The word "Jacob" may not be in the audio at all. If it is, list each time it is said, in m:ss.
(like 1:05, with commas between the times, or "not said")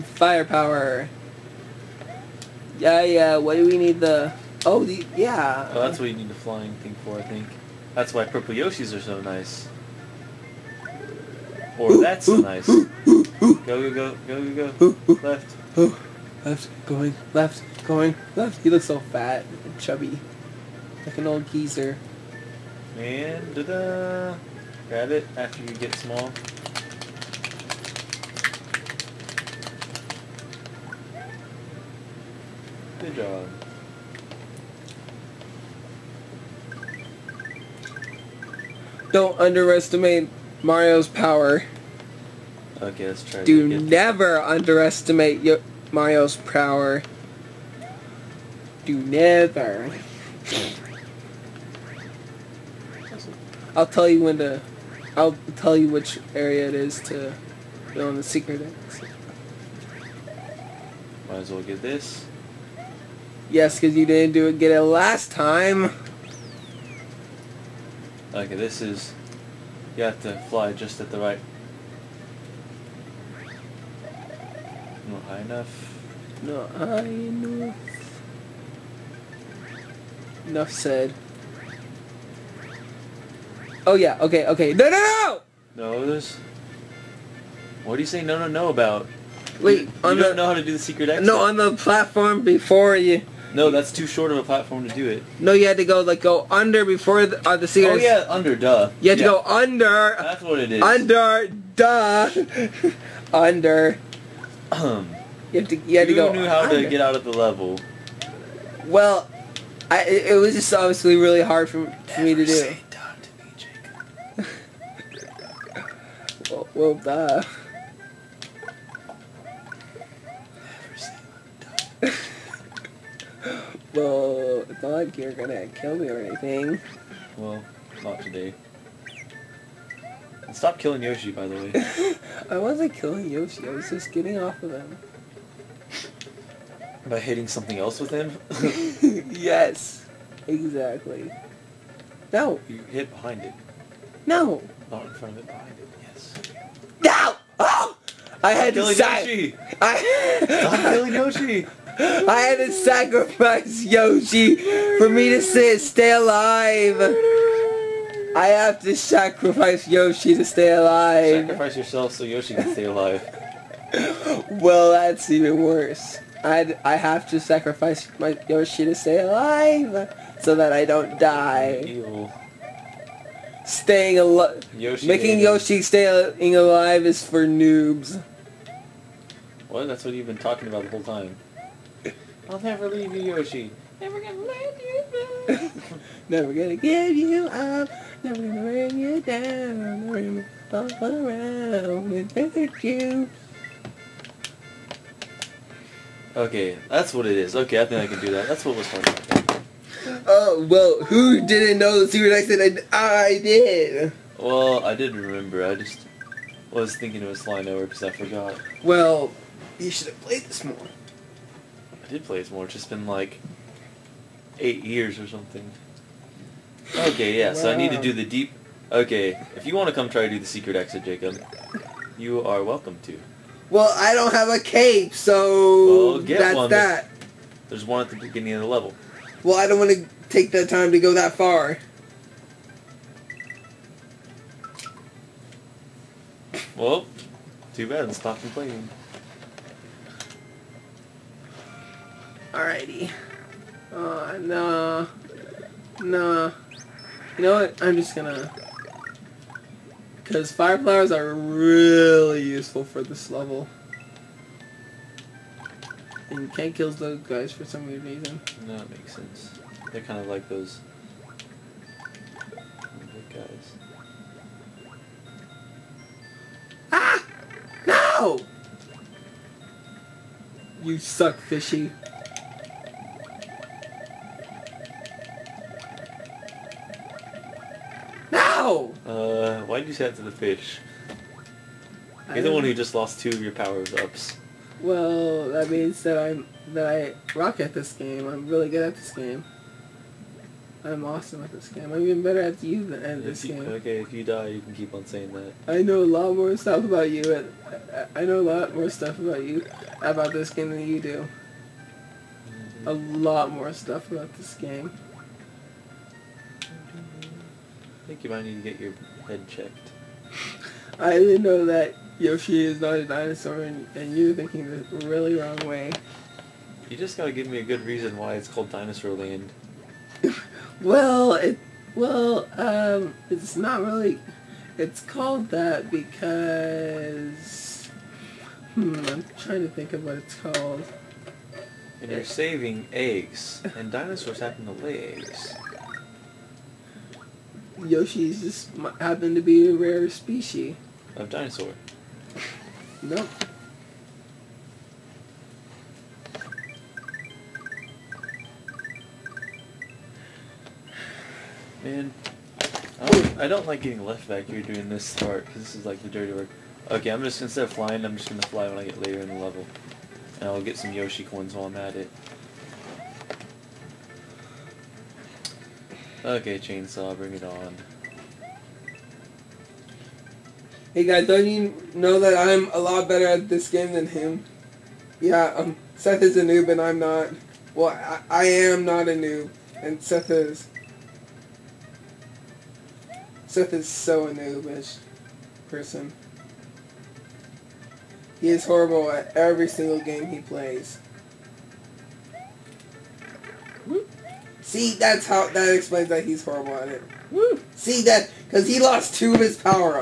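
1:55, 3:41.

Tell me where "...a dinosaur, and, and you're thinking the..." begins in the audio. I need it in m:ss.
5:12.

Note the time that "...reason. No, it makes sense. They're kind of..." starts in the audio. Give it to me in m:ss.
4:18.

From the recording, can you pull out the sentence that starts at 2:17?
By hitting something else with him?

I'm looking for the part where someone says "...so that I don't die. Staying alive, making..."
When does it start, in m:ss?
2:50.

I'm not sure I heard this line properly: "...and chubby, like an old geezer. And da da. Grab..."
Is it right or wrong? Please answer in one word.
right.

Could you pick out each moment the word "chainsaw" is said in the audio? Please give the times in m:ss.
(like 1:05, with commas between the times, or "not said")
6:06.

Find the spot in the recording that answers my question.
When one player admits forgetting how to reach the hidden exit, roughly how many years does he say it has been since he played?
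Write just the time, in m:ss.
3:34.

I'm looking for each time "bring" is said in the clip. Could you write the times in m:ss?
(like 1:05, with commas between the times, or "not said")
3:08, 6:07.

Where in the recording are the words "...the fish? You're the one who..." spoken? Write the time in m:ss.
4:40.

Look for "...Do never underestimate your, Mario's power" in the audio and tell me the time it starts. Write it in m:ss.
0:43.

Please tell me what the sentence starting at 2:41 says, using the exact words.
Sacrifice yourself so Yoshi can stay alive.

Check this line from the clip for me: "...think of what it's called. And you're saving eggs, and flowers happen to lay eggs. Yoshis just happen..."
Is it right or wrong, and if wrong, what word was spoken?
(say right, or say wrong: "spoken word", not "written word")
wrong: "dinosaurs", not "flowers".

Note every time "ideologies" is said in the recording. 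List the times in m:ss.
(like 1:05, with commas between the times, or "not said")
not said.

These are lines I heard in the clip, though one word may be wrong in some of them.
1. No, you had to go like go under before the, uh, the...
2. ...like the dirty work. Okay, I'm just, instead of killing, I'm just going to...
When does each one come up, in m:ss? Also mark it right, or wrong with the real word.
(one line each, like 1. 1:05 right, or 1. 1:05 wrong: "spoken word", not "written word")
1. 1:35 right
2. 5:55 wrong: "flying", not "killing".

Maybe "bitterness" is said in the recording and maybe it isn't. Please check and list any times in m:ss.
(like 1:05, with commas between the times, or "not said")
not said.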